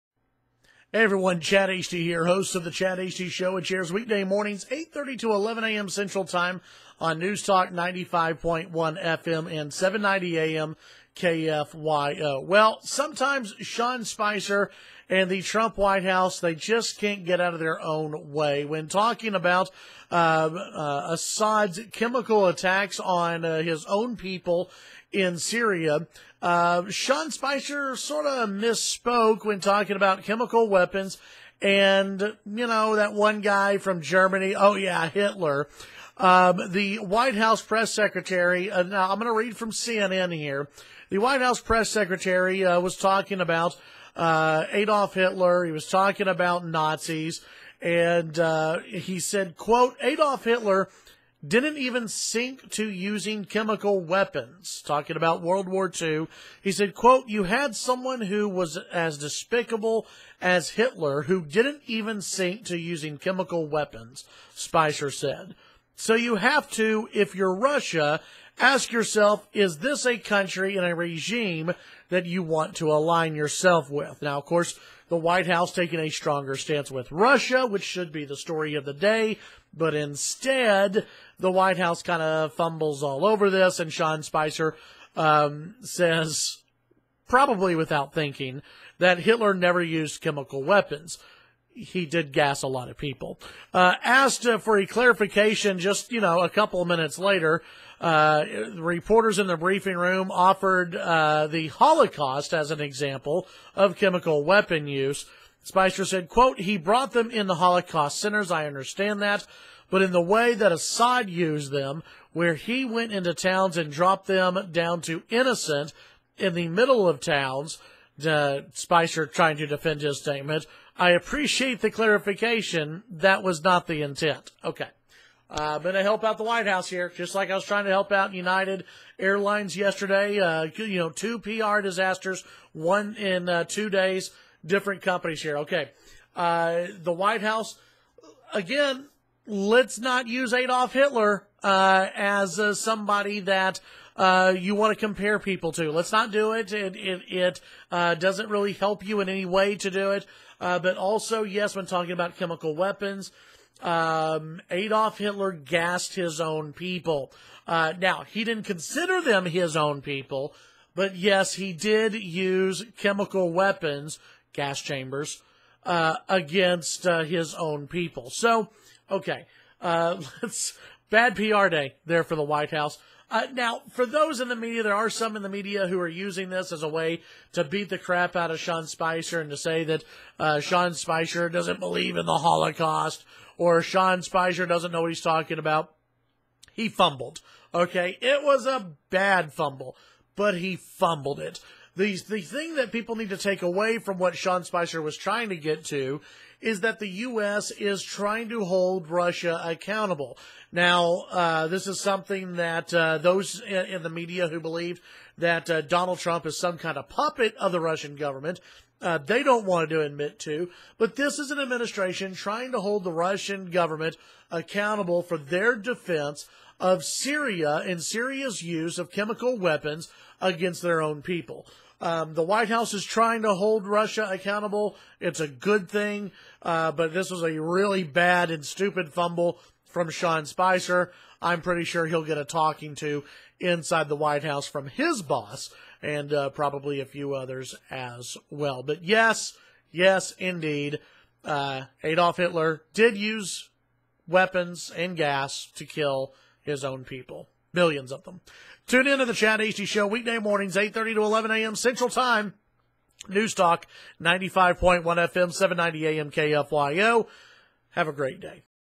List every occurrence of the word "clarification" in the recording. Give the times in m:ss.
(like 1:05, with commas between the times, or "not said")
1:34, 2:01.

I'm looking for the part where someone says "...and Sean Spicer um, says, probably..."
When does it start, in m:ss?
1:23.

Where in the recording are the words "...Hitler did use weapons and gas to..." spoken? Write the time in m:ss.
4:02.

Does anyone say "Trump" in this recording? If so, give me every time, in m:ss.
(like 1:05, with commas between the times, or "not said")
0:15, 3:26.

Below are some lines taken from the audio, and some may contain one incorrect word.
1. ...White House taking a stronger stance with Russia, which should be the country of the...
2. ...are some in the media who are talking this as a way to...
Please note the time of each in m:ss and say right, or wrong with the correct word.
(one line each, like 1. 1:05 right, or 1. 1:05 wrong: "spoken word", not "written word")
1. 1:15 wrong: "story", not "country"
2. 2:54 wrong: "using", not "talking".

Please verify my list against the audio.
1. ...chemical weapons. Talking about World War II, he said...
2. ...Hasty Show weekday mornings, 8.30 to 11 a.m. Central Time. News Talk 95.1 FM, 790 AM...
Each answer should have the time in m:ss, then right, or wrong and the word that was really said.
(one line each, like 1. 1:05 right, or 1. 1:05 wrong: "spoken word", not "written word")
1. 0:53 right
2. 4:09 right.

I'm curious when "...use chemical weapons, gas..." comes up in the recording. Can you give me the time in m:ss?
2:42.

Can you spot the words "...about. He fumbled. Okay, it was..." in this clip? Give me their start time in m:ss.
3:05.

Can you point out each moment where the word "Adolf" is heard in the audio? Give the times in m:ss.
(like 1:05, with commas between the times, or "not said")
0:44, 0:50, 2:20, 2:34, 4:02.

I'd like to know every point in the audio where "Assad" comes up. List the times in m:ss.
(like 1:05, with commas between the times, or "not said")
0:21, 1:50.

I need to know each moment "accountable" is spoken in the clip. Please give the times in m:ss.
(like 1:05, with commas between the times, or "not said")
3:19, 3:34, 3:44.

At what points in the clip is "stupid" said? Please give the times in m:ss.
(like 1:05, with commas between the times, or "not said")
3:48.